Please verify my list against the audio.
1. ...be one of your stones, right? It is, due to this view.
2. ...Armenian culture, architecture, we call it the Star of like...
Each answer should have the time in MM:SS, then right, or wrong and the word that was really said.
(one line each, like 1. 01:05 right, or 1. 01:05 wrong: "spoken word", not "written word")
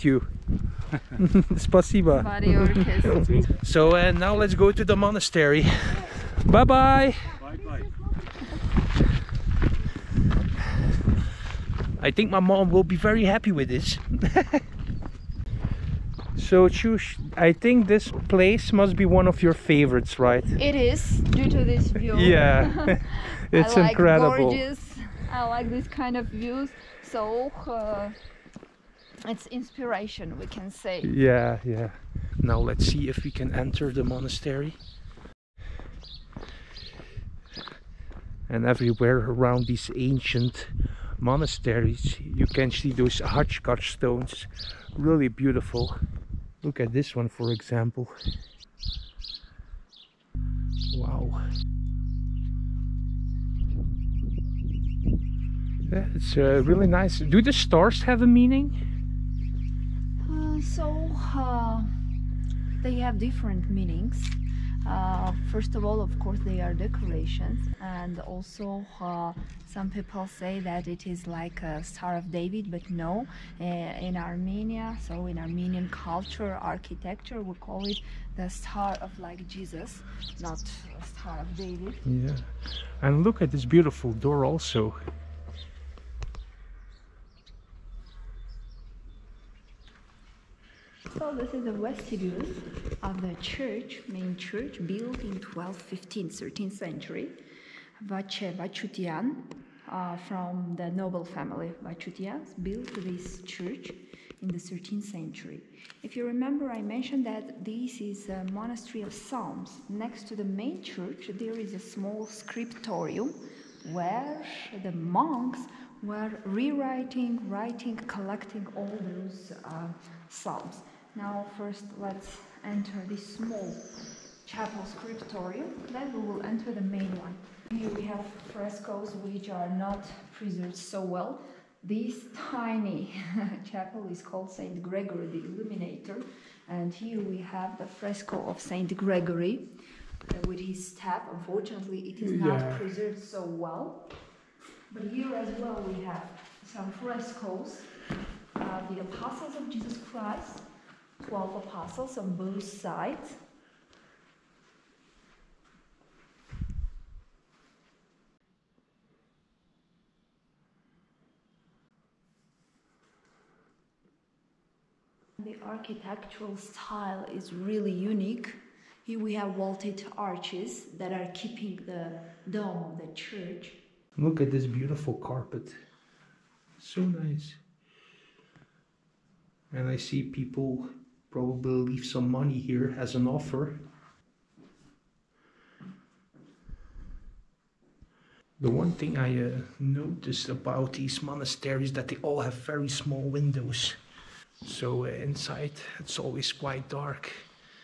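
1. 00:18 wrong: "favorites", not "stones"
2. 01:15 right.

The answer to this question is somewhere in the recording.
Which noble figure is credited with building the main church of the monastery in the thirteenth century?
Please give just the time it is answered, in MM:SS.
01:38.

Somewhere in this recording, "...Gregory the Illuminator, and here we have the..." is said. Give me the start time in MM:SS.
02:14.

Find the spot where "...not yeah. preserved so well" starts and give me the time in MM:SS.
02:22.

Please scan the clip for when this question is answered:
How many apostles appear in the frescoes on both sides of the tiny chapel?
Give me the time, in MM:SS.
02:31.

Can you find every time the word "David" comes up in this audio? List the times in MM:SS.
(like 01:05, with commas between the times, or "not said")
01:12, 01:21.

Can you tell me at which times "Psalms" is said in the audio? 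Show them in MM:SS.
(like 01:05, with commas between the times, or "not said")
01:49, 02:00.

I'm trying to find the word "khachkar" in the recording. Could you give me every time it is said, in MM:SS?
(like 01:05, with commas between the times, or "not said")
00:43.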